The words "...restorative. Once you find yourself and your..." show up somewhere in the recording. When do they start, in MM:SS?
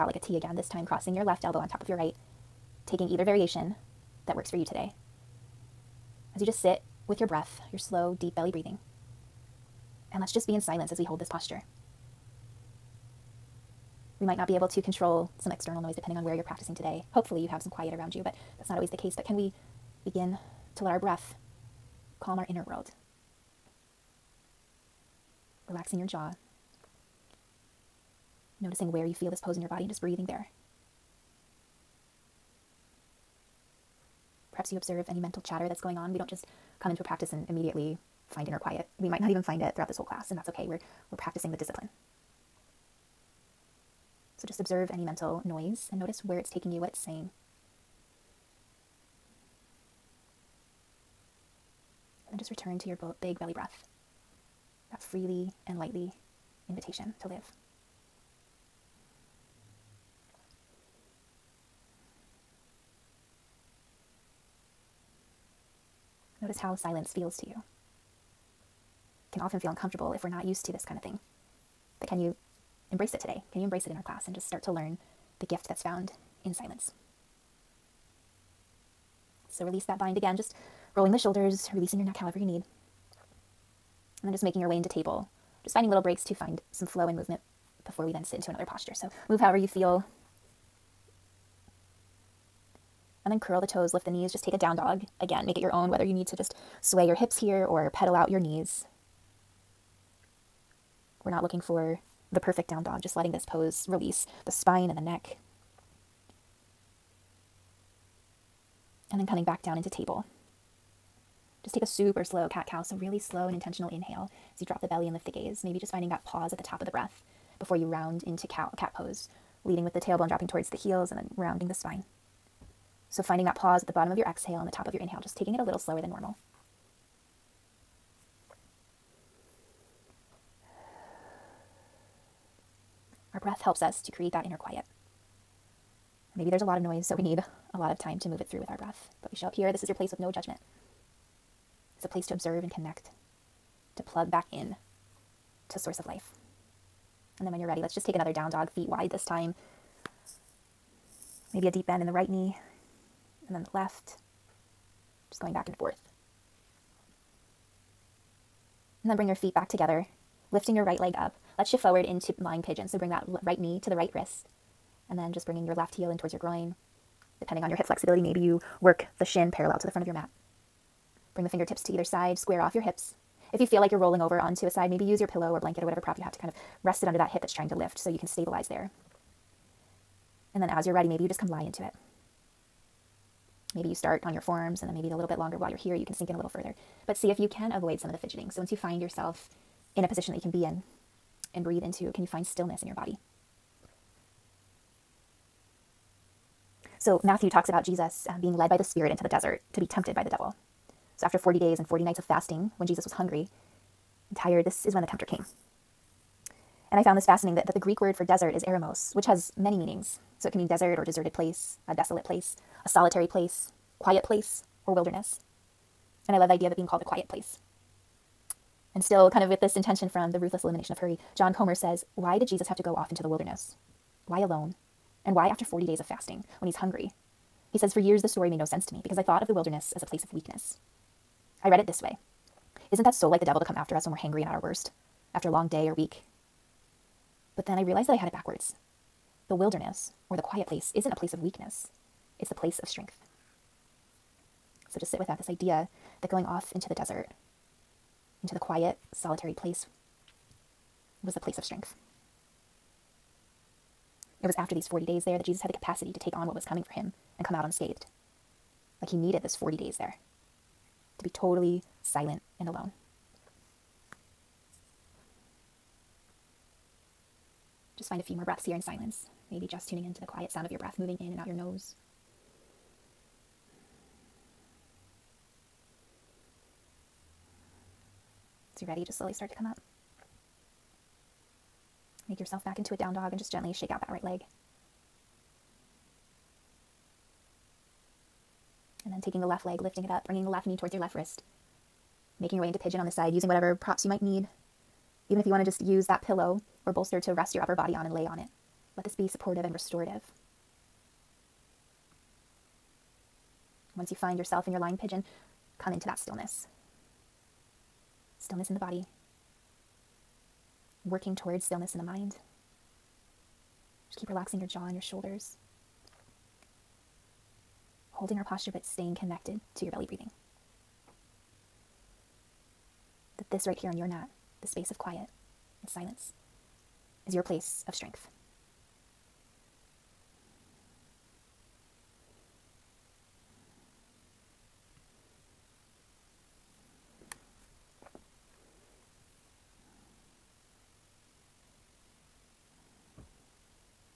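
04:59.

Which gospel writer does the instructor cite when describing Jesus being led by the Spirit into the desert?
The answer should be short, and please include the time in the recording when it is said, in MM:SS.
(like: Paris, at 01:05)
Matthew, at 03:17.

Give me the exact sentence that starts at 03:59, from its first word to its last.
The wilderness or the quiet place isn't a place of weakness, it's the place of strength.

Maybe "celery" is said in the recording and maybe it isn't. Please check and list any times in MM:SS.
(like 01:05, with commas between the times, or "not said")
not said.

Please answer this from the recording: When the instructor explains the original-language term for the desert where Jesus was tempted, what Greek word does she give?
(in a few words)
eremos.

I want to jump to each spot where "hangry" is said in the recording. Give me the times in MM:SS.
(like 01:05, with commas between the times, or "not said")
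03:54.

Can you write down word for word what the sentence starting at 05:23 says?
That this right here on your mat, this space of quiet and silence, is your place of strength.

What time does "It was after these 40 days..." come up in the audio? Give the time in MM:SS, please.
04:14.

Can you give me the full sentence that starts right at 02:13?
breath helps us to create that inner quiet.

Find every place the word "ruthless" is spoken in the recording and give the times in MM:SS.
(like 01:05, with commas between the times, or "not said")
03:40.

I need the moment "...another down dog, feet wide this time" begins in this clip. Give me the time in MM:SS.
02:28.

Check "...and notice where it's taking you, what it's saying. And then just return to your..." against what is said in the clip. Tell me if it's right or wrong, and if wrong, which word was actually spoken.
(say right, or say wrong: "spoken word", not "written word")
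right.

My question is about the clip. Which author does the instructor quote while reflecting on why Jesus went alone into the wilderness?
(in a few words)
John Comer.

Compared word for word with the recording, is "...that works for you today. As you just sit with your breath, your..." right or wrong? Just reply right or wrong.
right.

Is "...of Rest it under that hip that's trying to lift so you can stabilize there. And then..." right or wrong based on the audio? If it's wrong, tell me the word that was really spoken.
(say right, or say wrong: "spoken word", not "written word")
right.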